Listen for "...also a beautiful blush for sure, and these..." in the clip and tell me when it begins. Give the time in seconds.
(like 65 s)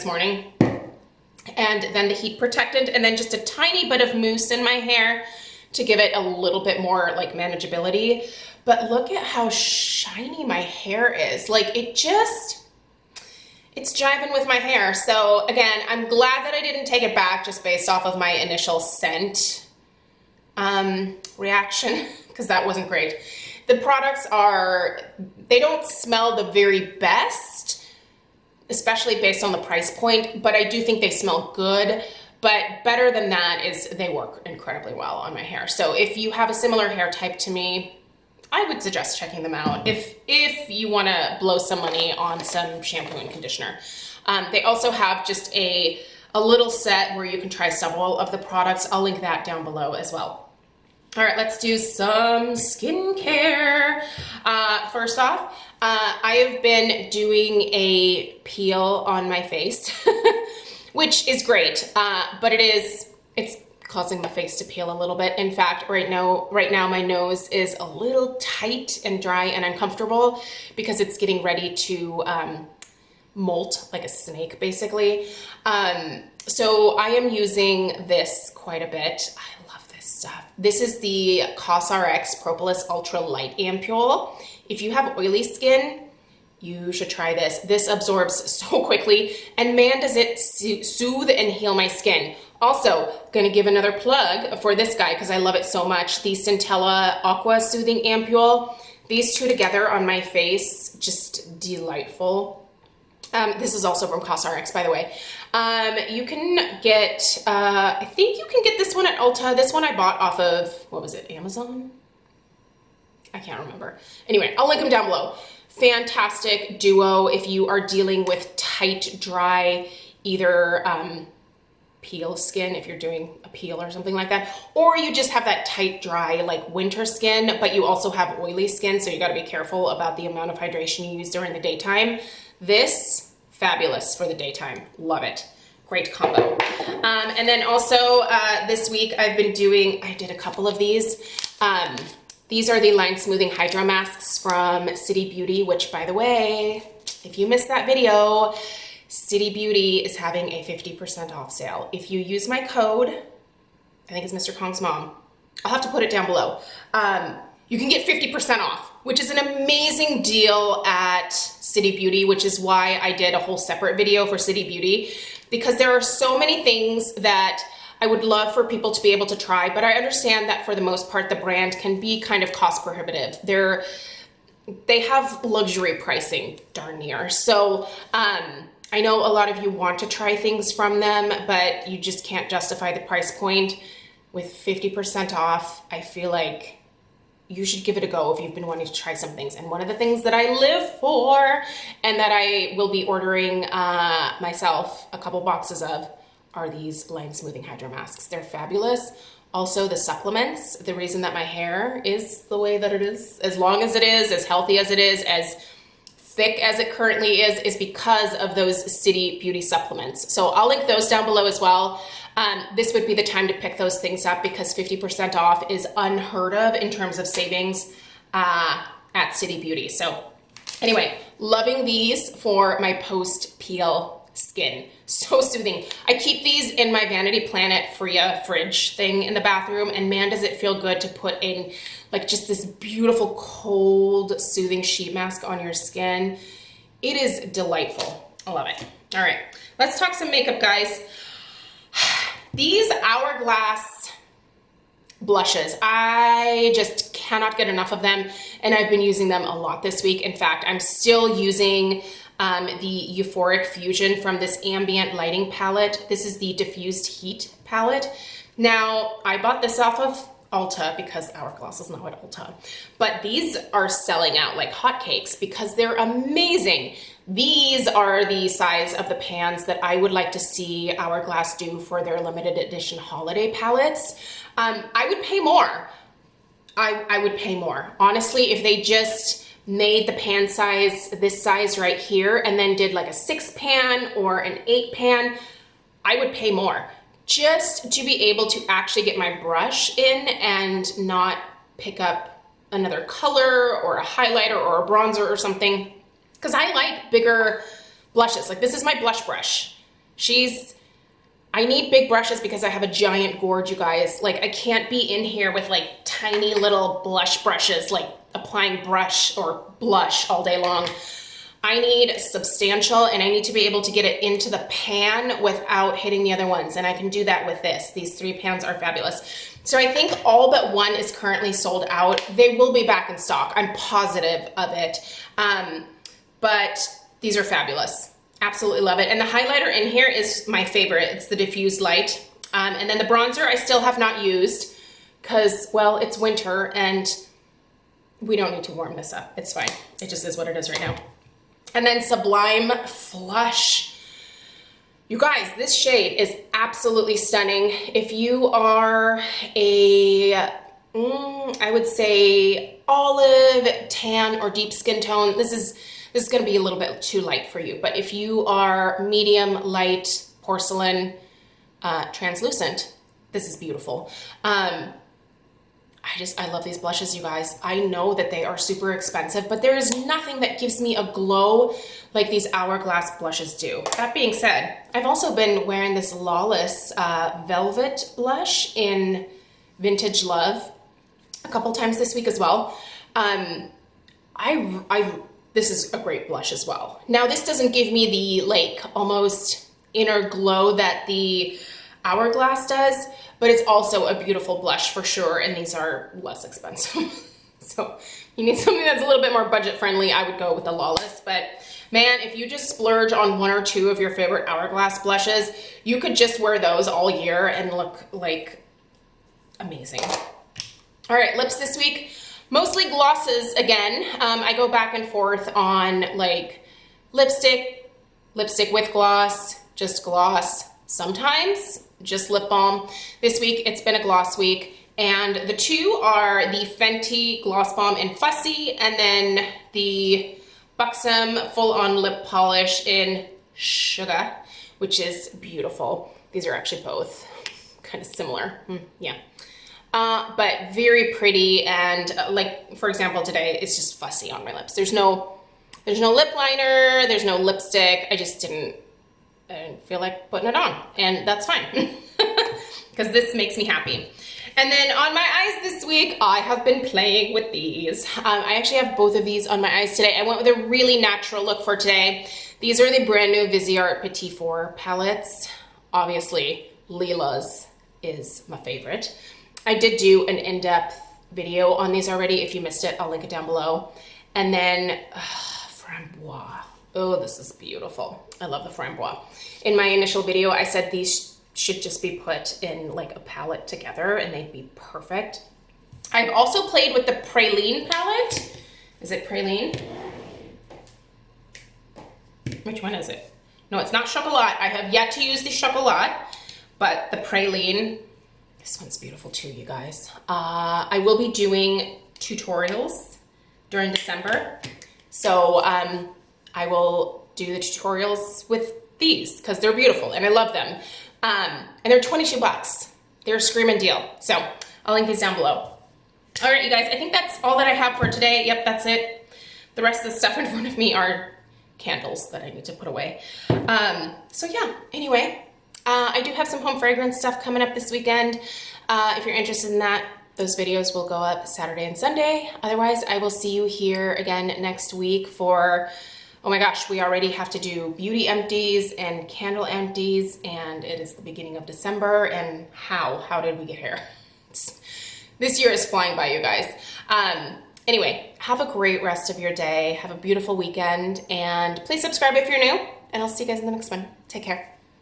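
393 s.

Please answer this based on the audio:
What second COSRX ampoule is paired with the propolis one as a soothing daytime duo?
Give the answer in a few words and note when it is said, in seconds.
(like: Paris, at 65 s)
Centella Aqua Soothing Ampule, at 96 s.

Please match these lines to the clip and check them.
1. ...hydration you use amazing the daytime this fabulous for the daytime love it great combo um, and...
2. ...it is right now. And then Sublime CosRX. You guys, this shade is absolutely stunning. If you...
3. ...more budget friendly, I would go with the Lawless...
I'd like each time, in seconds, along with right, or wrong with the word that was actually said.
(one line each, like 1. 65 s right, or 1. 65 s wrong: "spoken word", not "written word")
1. 130 s wrong: "during", not "amazing"
2. 340 s wrong: "Flush", not "CosRX"
3. 399 s right.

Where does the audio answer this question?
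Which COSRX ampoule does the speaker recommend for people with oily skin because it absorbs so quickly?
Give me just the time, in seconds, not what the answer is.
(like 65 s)
82 s.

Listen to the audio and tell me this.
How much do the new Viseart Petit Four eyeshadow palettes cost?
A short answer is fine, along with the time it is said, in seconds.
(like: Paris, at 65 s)
$22, at 512 s.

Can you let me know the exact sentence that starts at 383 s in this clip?
Um, I, I, this is a great blush as well.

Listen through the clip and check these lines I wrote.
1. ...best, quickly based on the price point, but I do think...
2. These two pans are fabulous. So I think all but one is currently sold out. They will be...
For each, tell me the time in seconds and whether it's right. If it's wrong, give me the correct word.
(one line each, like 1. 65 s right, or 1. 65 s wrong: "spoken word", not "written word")
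1. 26 s wrong: "especially", not "quickly"
2. 317 s wrong: "three", not "two".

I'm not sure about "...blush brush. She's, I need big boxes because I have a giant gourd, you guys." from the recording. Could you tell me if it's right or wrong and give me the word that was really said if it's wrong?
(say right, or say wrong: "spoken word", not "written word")
wrong: "brushes", not "boxes".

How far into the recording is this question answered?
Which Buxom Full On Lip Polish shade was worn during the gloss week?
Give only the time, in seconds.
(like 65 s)
433 s.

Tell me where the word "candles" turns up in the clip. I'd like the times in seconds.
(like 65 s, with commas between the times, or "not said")
521 s, 539 s.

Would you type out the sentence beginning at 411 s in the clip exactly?
All right, lips this week, mostly glosses again.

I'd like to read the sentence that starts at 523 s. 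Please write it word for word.
Um, so yeah, anyway, uh, I do have some home fragrance stuff coming up this weekend.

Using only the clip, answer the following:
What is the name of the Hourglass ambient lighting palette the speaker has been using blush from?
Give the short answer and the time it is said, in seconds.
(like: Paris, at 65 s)
Diffused Heat, at 256 s.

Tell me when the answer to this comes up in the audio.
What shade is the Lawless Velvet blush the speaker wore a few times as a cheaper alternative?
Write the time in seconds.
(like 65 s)
379 s.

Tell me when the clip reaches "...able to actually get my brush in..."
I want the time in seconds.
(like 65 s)
288 s.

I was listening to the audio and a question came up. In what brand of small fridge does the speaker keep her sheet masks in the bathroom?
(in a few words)
Vanity Planet.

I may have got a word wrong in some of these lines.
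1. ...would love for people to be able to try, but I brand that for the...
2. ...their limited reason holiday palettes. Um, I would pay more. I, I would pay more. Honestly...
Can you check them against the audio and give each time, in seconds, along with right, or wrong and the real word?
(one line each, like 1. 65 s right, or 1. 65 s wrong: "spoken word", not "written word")
1. 168 s wrong: "understand", not "brand"
2. 272 s wrong: "edition", not "reason".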